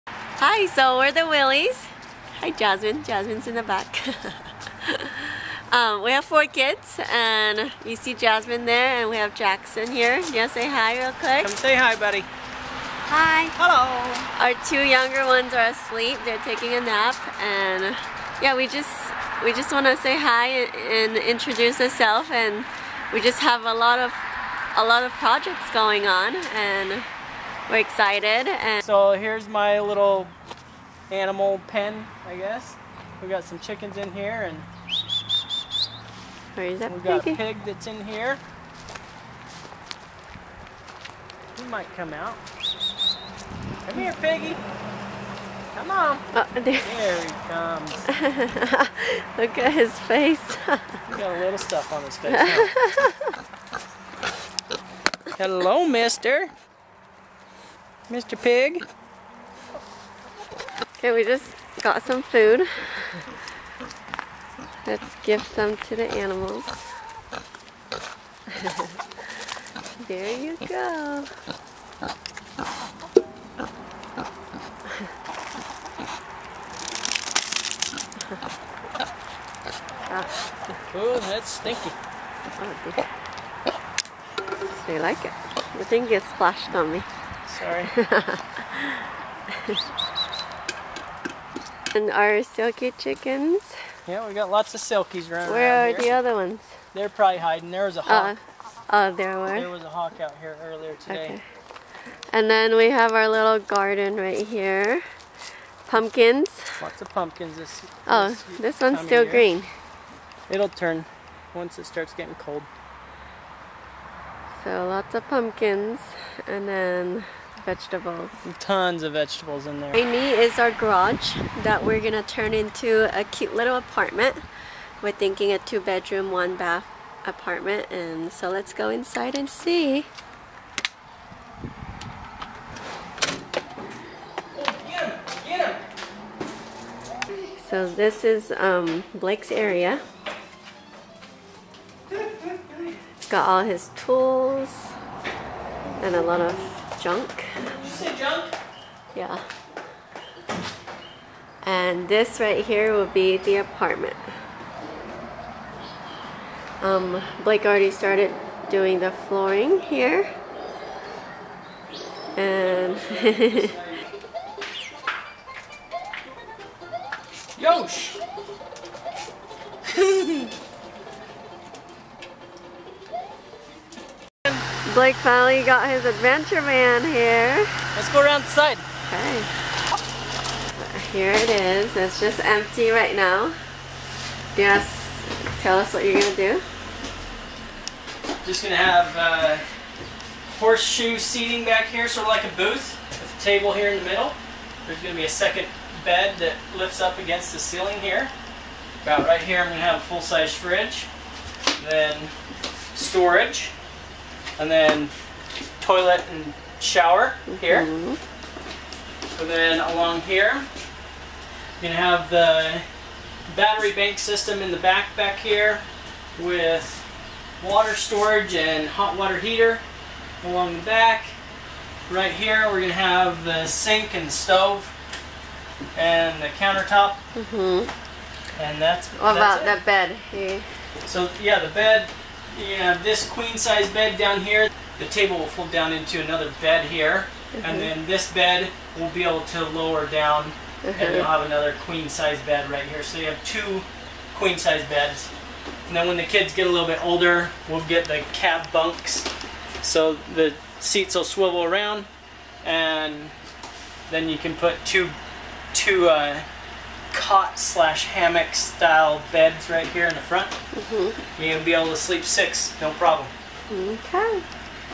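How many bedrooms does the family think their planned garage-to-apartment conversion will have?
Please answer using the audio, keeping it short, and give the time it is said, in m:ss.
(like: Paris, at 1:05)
2, at 2:05.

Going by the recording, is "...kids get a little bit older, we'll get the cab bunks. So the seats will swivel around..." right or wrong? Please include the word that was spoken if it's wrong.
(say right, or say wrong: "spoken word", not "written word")
right.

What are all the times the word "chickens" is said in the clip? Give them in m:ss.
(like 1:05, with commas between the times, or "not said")
0:33, 1:32.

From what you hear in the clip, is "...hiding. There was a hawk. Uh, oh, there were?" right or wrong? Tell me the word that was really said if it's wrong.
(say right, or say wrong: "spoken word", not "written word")
right.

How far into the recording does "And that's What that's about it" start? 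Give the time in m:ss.
3:48.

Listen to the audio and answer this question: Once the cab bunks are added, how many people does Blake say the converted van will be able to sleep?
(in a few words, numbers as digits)
6.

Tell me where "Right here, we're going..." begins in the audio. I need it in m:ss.
3:42.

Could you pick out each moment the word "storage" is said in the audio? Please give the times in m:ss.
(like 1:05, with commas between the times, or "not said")
3:22, 3:37.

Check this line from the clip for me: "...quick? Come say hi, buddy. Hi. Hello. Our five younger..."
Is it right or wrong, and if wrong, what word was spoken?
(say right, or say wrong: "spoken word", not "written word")
wrong: "two", not "five".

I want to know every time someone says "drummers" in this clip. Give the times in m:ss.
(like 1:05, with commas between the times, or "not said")
not said.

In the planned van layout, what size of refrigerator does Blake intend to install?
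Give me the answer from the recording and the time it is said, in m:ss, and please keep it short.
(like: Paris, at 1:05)
Full-size, at 3:20.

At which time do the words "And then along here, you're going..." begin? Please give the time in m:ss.
3:29.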